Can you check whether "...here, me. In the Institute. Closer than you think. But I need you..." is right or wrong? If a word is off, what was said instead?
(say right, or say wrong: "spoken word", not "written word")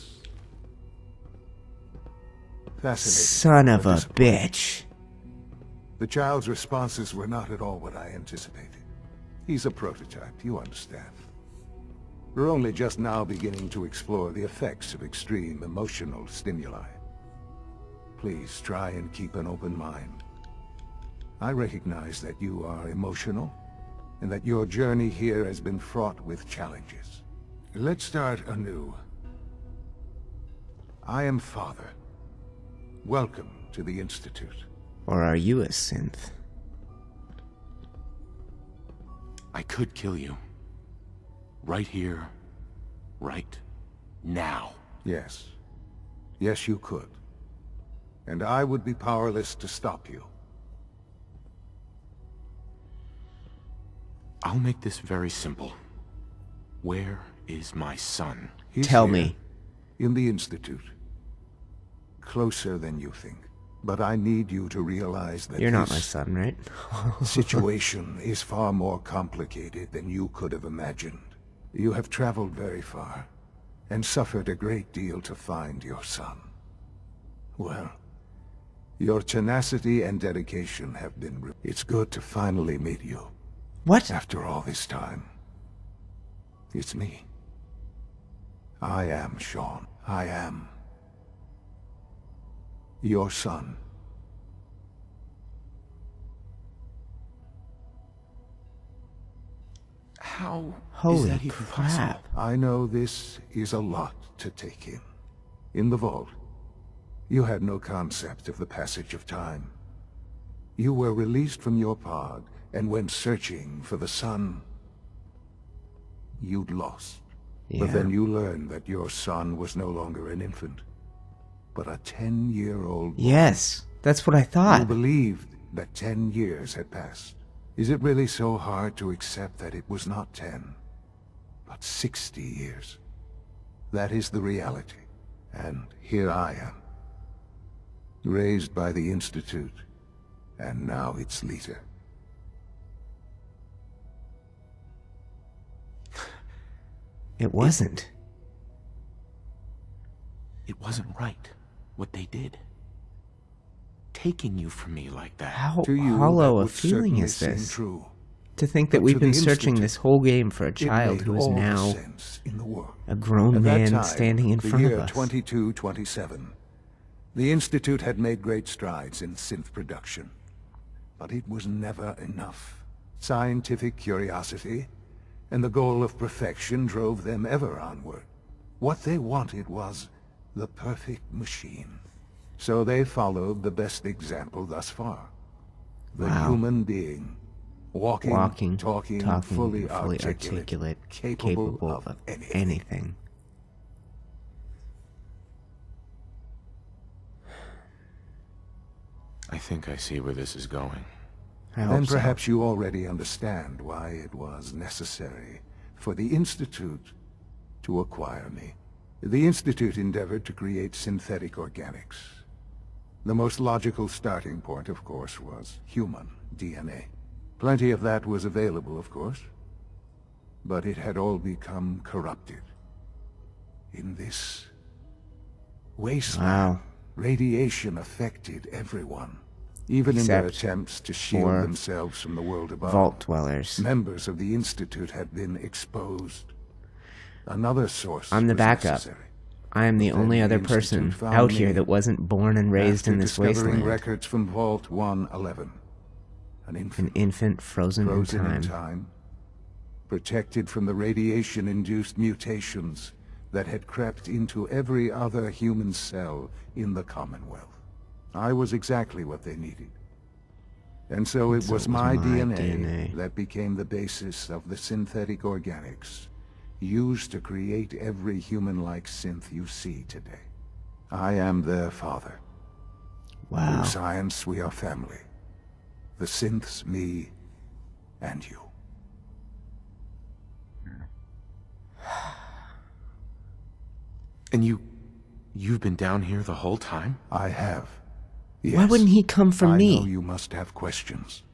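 right.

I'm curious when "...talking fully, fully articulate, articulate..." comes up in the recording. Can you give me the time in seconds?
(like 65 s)
189 s.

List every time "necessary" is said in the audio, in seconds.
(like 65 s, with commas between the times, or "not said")
204 s, 238 s.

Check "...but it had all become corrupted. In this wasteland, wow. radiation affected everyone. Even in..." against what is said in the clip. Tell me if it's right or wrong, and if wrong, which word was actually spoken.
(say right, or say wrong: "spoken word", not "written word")
right.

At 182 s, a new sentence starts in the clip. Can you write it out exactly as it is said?
So they followed the best example thus far.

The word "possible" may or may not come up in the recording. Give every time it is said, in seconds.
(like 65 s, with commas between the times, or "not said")
101 s.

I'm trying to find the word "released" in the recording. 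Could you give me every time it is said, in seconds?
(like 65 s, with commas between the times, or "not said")
111 s.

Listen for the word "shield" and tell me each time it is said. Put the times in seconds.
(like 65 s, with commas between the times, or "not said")
231 s.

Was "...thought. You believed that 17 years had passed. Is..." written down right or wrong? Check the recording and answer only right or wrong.
wrong.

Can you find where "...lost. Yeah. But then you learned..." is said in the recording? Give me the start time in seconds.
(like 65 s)
116 s.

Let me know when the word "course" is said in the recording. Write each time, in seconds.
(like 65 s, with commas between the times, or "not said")
215 s, 219 s.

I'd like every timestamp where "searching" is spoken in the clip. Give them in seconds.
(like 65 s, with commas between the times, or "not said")
113 s, 159 s.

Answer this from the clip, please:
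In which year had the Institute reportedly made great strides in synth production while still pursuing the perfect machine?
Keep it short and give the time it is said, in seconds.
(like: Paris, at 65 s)
2227, at 165 s.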